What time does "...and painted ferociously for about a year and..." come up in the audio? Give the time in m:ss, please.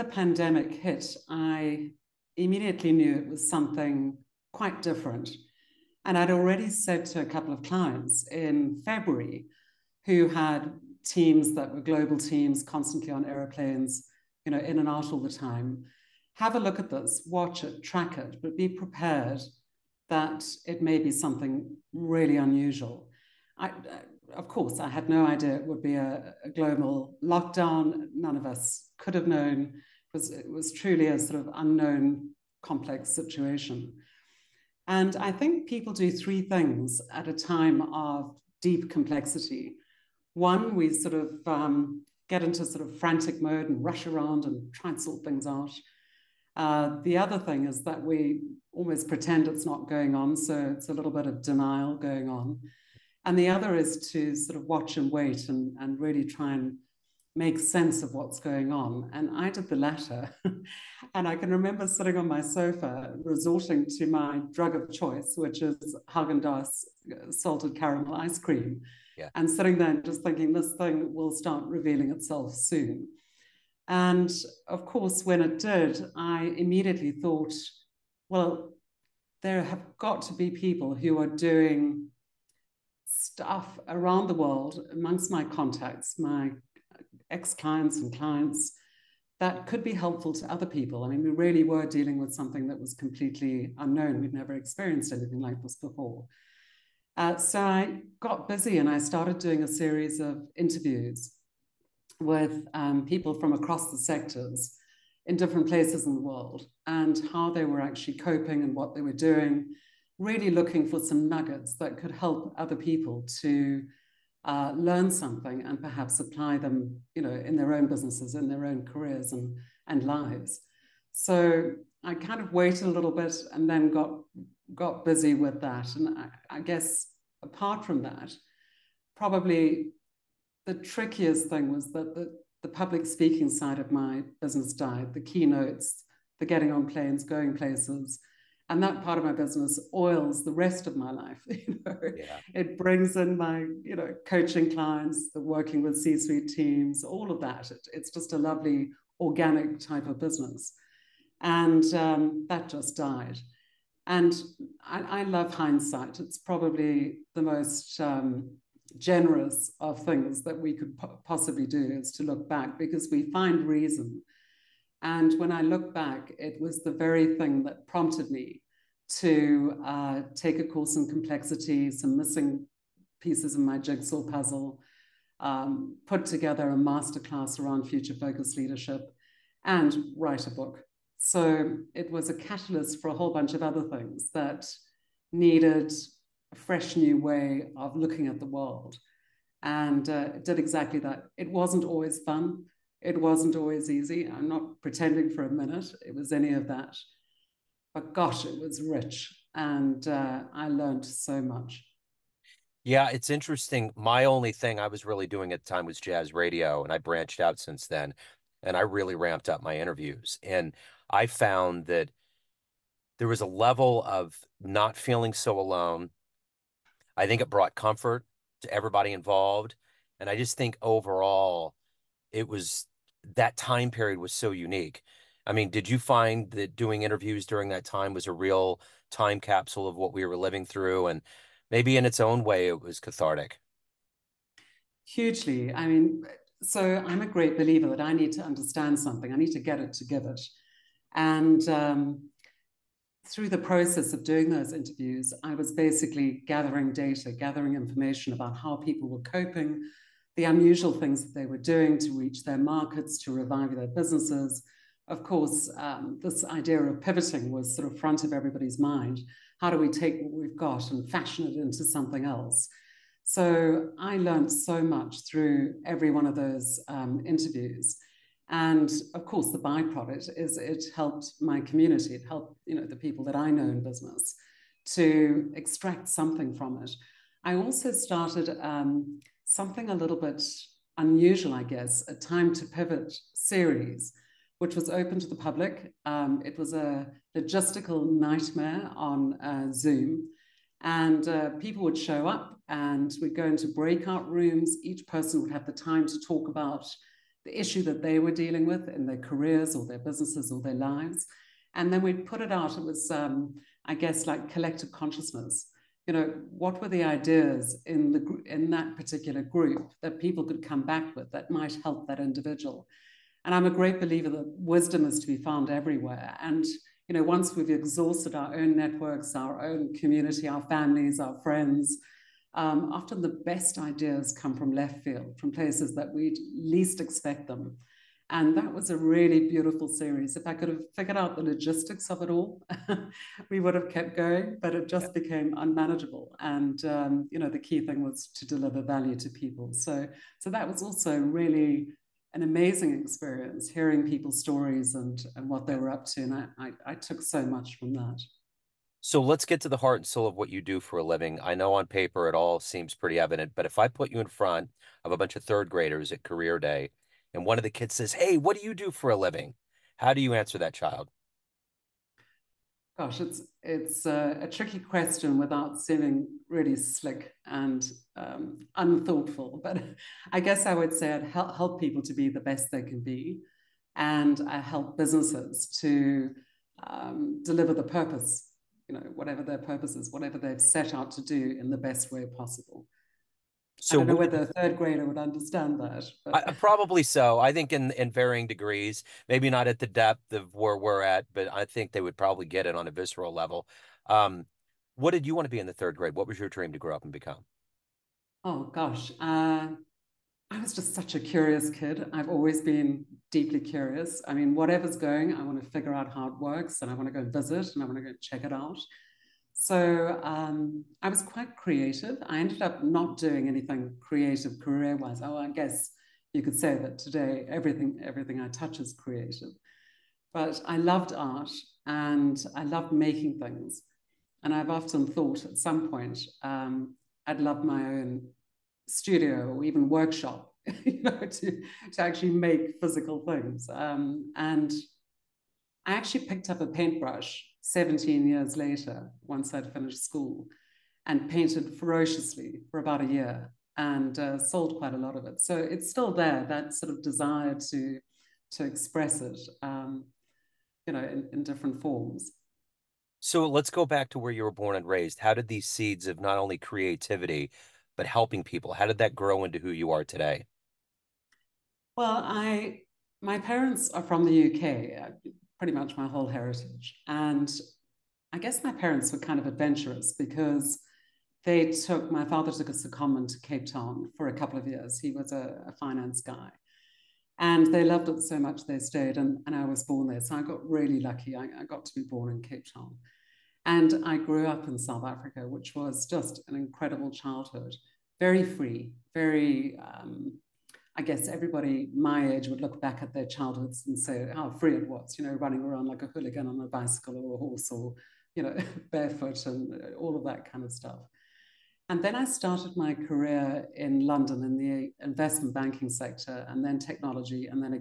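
7:21.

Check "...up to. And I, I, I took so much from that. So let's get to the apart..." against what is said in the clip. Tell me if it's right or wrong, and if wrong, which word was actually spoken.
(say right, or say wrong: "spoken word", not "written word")
wrong: "heart", not "apart".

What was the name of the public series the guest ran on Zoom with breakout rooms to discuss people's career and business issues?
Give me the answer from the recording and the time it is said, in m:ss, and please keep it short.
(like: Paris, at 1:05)
Time to Pivot, at 4:42.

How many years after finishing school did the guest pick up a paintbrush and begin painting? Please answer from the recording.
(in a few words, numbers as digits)
17.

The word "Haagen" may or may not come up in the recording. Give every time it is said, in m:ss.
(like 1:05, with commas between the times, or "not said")
1:06.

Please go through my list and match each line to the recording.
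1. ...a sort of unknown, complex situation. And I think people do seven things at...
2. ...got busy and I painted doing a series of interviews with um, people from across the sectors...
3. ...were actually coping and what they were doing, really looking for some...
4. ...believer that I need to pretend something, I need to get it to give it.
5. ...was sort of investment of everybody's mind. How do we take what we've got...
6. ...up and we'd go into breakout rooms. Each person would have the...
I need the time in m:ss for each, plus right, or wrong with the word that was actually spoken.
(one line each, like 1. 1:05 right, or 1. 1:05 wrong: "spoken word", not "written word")
1. 0:31 wrong: "three", not "seven"
2. 1:38 wrong: "started", not "painted"
3. 1:47 right
4. 3:57 wrong: "understand", not "pretend"
5. 4:17 wrong: "front", not "investment"
6. 4:52 right.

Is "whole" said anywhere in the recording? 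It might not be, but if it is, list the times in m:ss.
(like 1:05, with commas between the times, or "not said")
3:03, 7:46.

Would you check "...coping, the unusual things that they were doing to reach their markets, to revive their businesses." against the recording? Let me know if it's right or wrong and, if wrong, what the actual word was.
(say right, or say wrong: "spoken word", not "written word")
right.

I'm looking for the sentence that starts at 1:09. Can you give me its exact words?
and sitting there just thinking this thing will start revealing itself soon.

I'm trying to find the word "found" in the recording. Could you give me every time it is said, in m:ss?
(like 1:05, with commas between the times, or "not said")
3:31, 5:15.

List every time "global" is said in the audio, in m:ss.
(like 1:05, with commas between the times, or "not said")
0:11, 0:26.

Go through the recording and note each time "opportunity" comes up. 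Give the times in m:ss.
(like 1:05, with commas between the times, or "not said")
not said.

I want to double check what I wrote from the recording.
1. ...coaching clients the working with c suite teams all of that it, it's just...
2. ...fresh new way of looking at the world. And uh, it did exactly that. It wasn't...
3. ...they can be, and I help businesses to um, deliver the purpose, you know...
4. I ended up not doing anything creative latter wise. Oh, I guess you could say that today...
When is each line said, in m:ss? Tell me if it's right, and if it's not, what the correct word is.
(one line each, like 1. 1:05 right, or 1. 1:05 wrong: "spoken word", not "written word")
1. 2:24 right
2. 3:06 right
3. 6:12 right
4. 6:52 wrong: "career", not "latter".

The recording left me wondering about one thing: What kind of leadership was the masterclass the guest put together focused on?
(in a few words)
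Future focused leadership.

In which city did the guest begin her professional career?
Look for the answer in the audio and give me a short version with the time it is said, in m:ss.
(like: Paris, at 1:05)
London, at 8:24.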